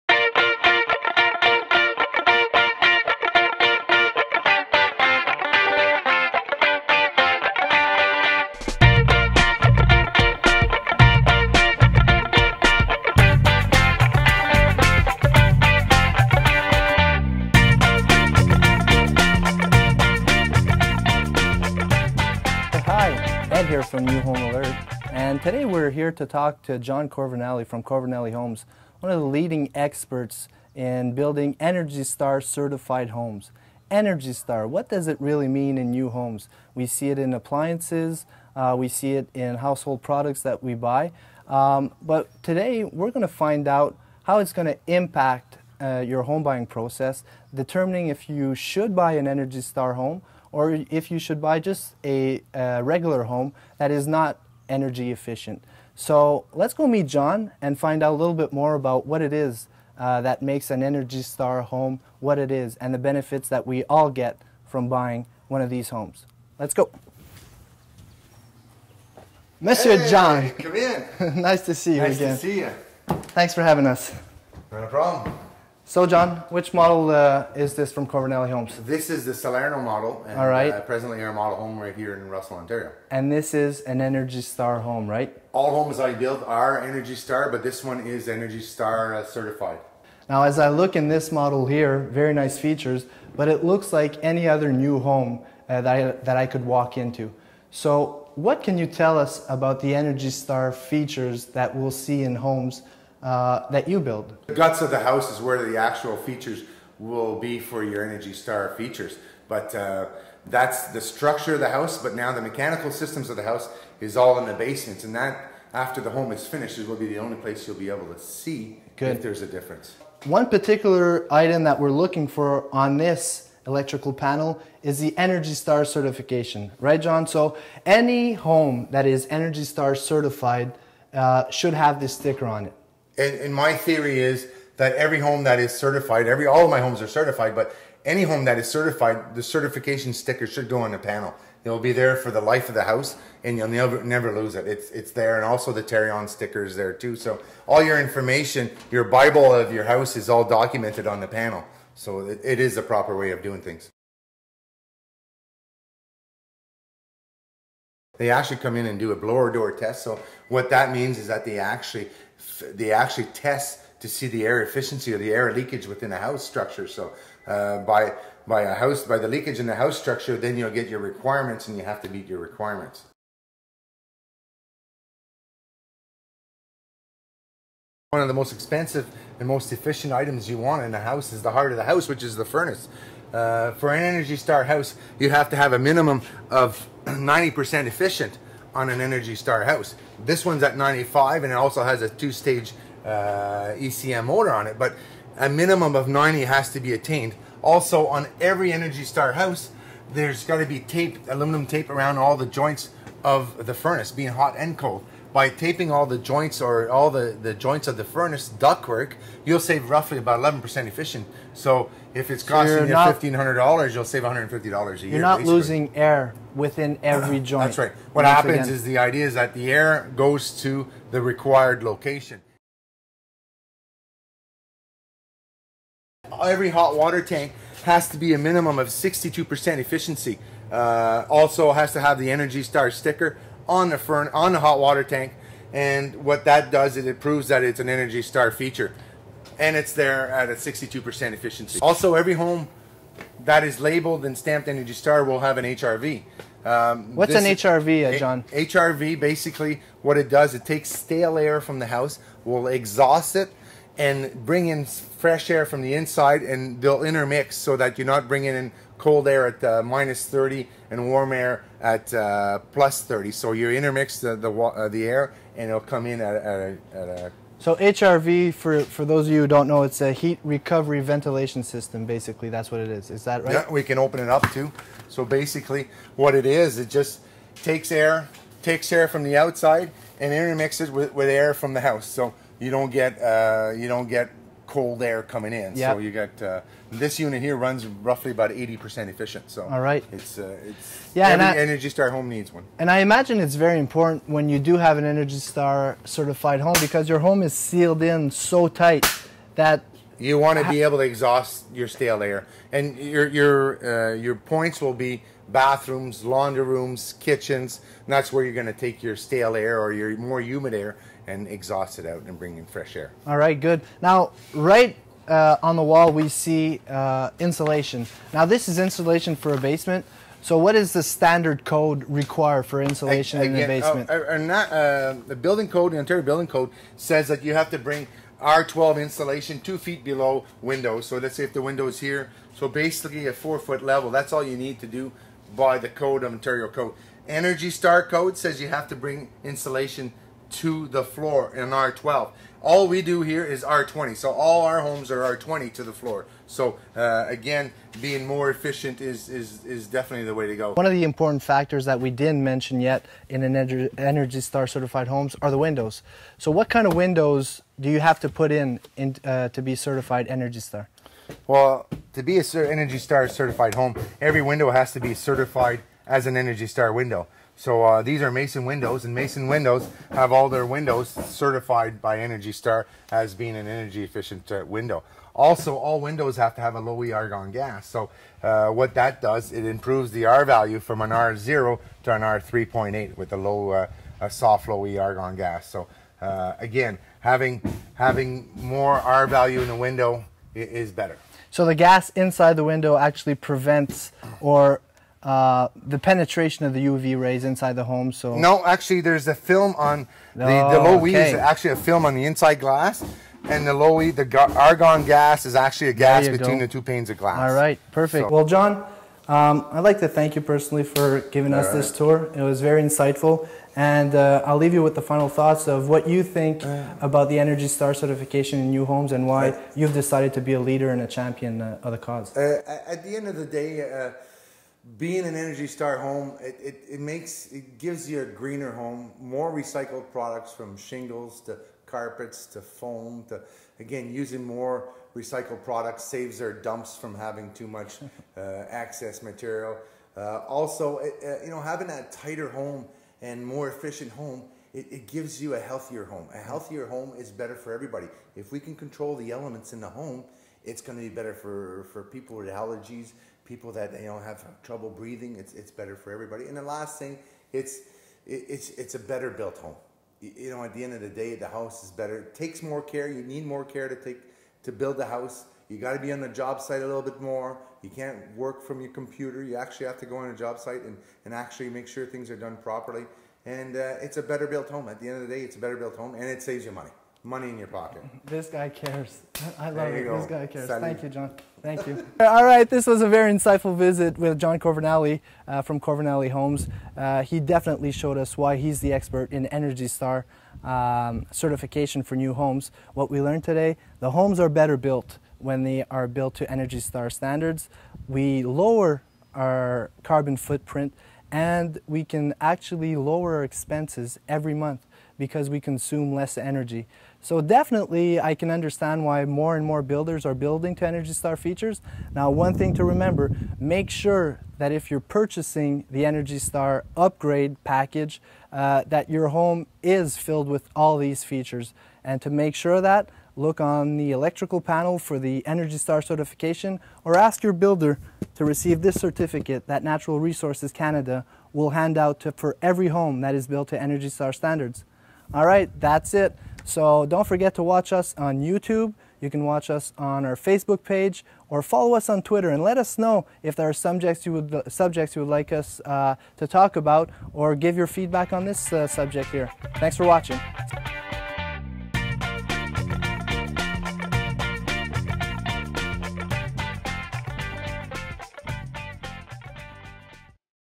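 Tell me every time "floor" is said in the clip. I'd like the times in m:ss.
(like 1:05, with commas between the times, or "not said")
5:41, 5:45.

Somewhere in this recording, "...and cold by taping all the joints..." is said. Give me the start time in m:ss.
3:24.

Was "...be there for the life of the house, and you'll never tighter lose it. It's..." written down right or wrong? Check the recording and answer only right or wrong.
wrong.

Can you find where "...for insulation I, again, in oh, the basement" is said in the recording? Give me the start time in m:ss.
5:22.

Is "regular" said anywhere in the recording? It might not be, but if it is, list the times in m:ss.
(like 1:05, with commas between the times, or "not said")
0:52.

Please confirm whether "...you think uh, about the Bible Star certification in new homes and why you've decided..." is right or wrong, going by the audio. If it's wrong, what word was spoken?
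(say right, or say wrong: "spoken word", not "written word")
wrong: "Energy", not "Bible".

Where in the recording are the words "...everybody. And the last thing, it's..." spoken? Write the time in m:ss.
7:36.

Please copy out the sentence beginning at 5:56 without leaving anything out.
So what kind of windows do you have to put in, in uh, to be certified Energy Star?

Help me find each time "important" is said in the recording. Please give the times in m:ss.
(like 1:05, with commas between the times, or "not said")
4:53, 5:51.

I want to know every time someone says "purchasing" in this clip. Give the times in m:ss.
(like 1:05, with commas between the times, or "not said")
8:34.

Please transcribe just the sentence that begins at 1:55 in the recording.
And that, after the home is finished, is will be the only place you'll be able to see Good.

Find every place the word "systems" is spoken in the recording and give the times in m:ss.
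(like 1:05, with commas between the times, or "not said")
1:52, 4:31.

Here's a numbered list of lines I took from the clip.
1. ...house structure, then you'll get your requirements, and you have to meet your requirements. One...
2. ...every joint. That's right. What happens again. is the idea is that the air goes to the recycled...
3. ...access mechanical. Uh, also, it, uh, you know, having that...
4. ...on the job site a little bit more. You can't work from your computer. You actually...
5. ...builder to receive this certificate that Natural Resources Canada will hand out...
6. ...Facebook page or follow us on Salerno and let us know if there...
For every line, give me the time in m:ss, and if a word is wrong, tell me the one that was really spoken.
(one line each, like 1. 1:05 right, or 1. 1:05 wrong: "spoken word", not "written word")
1. 2:49 right
2. 3:37 wrong: "required", not "recycled"
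3. 7:18 wrong: "material", not "mechanical"
4. 7:46 right
5. 8:47 right
6. 9:00 wrong: "Twitter", not "Salerno".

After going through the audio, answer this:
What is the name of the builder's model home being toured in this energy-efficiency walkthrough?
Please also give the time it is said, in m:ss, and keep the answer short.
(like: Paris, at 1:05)
Salerno, at 1:19.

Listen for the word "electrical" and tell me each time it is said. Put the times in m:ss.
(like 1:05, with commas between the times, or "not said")
2:03, 8:44.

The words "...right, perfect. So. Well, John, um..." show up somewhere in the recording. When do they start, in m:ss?
6:47.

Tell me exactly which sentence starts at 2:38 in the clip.
They actually come in and do a blower door test.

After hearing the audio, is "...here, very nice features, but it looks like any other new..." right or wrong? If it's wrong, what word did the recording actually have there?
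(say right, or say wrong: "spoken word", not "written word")
right.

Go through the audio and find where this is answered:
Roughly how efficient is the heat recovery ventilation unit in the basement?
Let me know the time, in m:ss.
4:48.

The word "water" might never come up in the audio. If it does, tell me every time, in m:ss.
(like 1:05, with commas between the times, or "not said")
3:46, 3:54.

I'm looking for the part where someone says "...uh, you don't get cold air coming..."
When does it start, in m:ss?
4:43.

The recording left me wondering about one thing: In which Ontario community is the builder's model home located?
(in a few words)
Russell.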